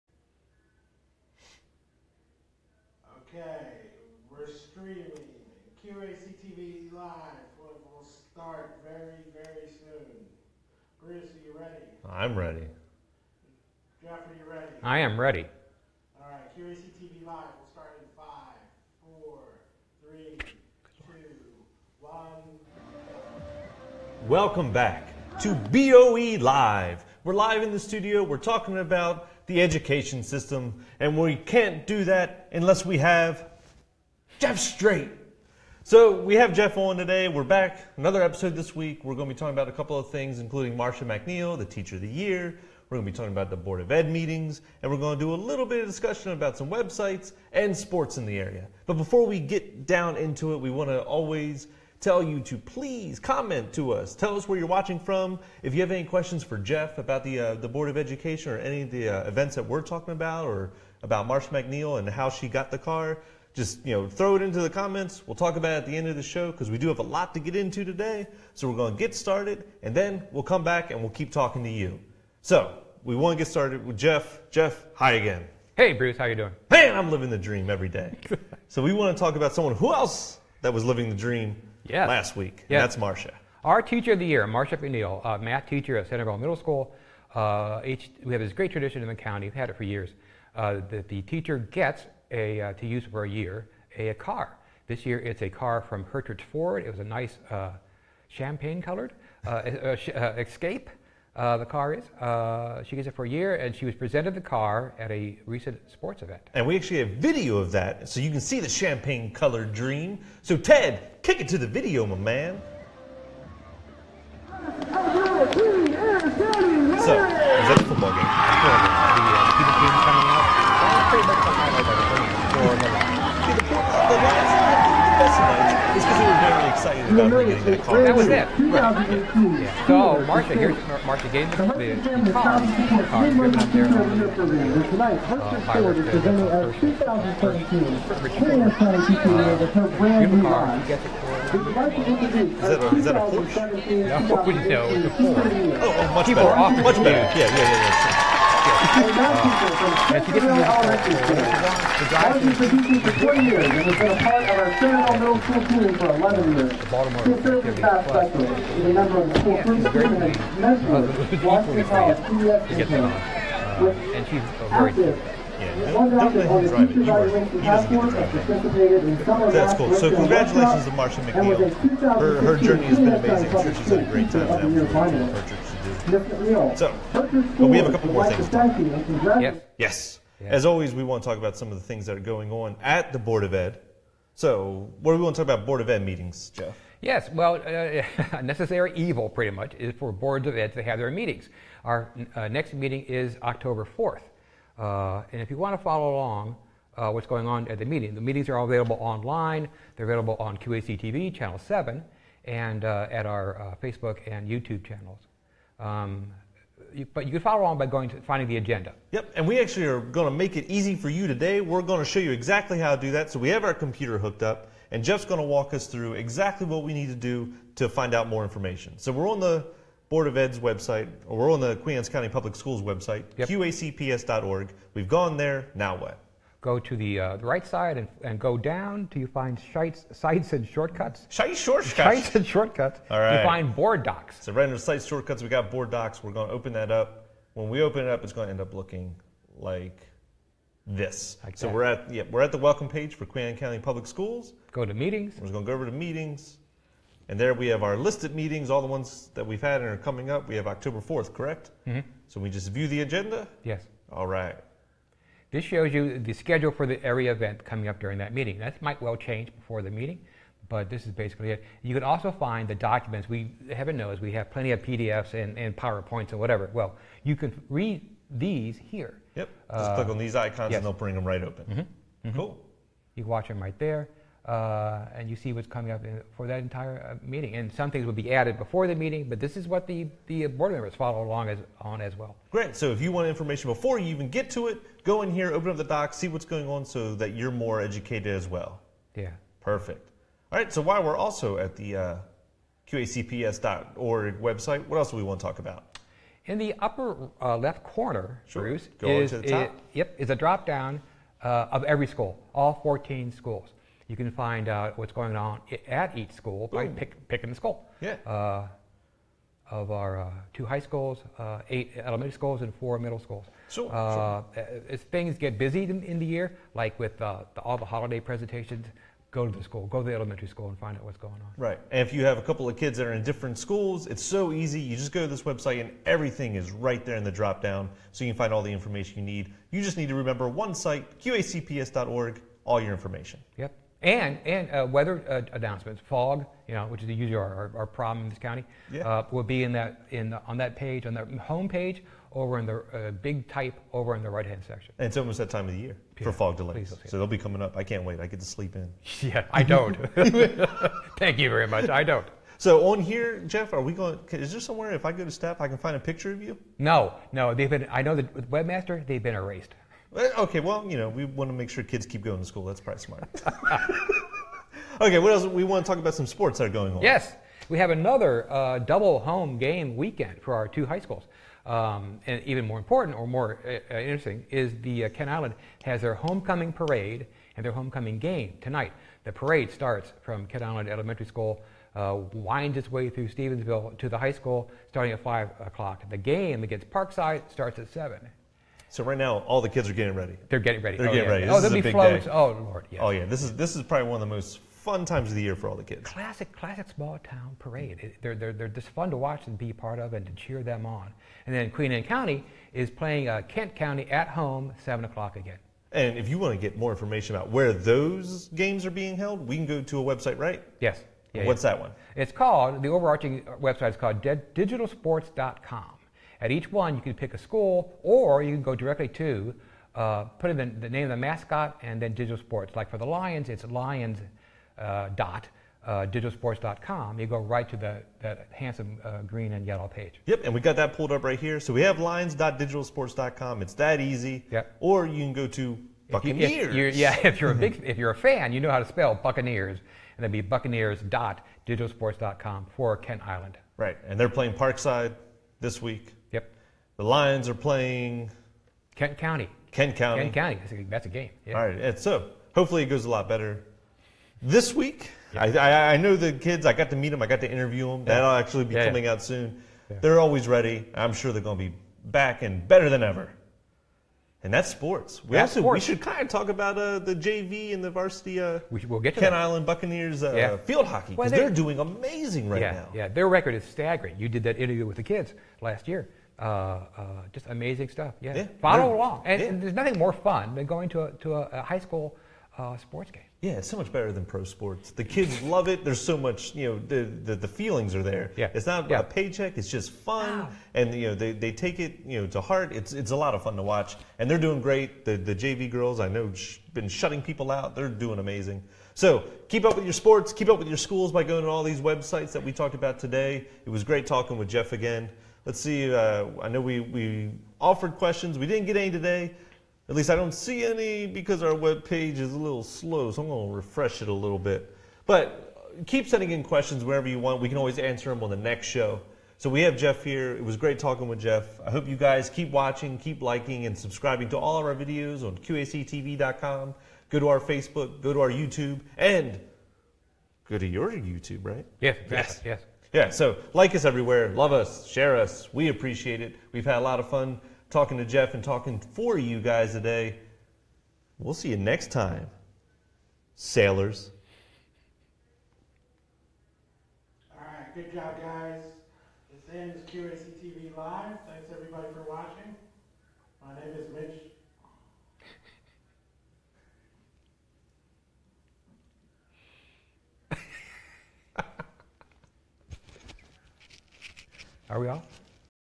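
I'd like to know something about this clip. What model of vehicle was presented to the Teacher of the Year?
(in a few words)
Escape.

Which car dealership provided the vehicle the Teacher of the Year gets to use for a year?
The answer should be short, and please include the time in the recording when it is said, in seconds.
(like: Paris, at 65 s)
Hertrich Ford, at 96 s.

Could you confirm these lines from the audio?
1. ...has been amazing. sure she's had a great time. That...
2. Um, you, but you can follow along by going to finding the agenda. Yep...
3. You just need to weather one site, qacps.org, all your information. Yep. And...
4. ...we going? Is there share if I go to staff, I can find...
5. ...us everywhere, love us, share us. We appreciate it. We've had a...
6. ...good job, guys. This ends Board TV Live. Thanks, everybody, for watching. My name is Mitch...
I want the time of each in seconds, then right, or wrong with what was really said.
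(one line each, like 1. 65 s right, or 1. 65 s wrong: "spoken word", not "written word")
1. 172 s right
2. 205 s right
3. 329 s wrong: "remember", not "weather"
4. 353 s wrong: "somewhere", not "share"
5. 533 s right
6. 547 s wrong: "QAC", not "Board".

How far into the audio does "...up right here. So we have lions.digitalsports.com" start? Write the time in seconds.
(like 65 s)
431 s.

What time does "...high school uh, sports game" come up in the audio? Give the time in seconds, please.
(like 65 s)
481 s.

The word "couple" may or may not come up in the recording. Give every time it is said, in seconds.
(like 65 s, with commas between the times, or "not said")
39 s, 177 s, 322 s.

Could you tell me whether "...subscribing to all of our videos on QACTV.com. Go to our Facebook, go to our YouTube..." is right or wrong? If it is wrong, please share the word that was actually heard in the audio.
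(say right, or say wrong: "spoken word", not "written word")
right.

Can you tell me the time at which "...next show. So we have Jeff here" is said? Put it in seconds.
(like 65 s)
518 s.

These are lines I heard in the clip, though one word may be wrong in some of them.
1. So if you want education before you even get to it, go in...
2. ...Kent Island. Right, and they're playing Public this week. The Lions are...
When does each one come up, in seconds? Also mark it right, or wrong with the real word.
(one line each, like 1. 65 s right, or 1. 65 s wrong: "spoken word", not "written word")
1. 282 s wrong: "information", not "education"
2. 442 s wrong: "Parkside", not "Public".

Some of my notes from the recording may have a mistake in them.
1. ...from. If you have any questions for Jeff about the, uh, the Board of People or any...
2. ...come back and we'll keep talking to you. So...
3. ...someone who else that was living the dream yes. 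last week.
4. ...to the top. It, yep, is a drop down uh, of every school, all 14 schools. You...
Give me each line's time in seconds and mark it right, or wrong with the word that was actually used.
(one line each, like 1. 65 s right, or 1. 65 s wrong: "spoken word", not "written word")
1. 54 s wrong: "Education", not "People"
2. 70 s right
3. 79 s right
4. 299 s right.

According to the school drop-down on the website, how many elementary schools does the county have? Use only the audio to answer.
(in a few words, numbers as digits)
8.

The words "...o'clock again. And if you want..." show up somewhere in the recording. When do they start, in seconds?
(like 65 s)
405 s.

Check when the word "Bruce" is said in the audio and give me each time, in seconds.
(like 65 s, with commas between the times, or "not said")
11 s, 75 s, 298 s.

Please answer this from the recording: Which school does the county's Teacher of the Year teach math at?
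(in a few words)
Centreville Middle School.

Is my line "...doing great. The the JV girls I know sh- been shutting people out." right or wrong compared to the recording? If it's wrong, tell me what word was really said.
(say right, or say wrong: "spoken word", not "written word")
right.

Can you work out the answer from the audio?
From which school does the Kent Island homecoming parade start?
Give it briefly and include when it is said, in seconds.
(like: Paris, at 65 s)
Kent Island Elementary School, at 380 s.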